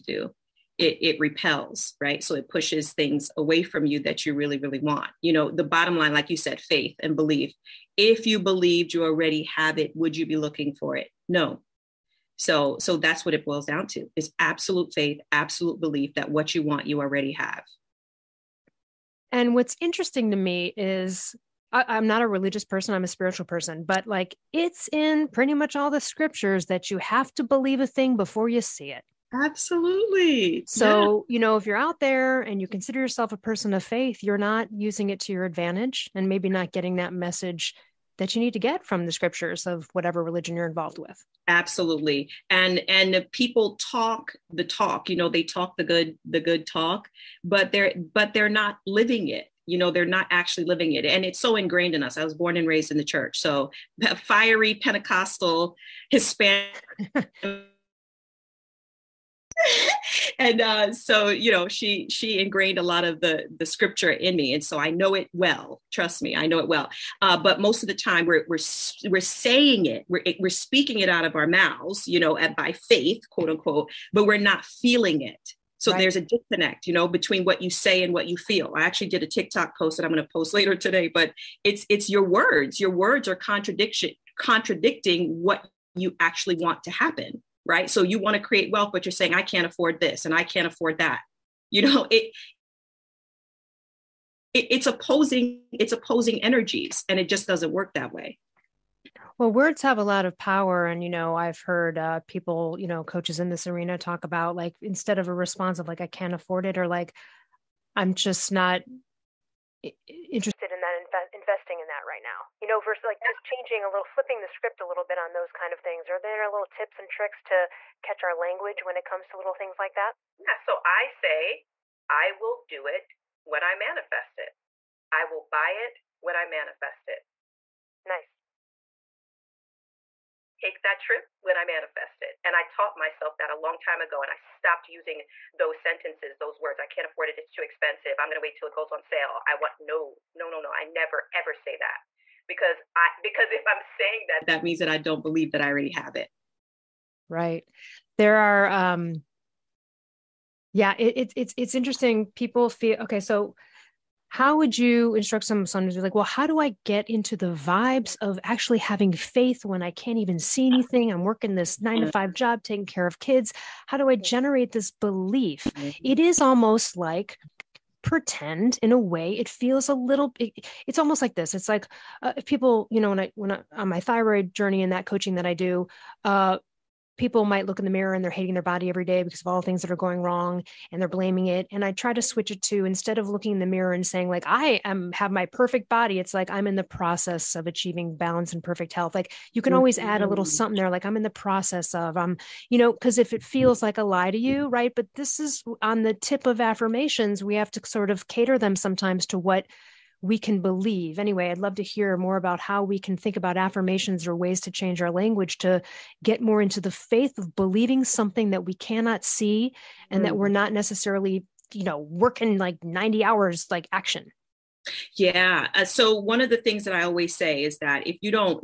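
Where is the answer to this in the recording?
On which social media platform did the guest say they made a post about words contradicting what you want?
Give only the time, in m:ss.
1:19.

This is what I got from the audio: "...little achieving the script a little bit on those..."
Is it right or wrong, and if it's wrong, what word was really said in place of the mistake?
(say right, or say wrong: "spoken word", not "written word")
wrong: "flipping", not "achieving".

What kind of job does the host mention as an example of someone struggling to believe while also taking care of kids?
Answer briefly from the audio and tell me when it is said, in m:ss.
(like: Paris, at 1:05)
nine to five, at 2:41.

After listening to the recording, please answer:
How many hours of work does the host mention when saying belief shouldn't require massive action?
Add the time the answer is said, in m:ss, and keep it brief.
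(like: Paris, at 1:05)
90, at 3:32.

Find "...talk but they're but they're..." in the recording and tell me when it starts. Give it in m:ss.
0:46.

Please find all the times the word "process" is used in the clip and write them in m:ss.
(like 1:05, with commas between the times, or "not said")
3:06, 3:11.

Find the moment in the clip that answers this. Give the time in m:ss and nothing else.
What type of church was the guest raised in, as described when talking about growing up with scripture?
0:54.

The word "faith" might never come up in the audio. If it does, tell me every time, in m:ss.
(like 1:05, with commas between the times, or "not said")
0:06, 0:14, 0:33, 1:12, 2:39, 3:26.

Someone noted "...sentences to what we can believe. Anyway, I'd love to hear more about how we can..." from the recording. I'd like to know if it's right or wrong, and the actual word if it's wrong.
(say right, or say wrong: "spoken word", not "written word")
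wrong: "sometimes", not "sentences".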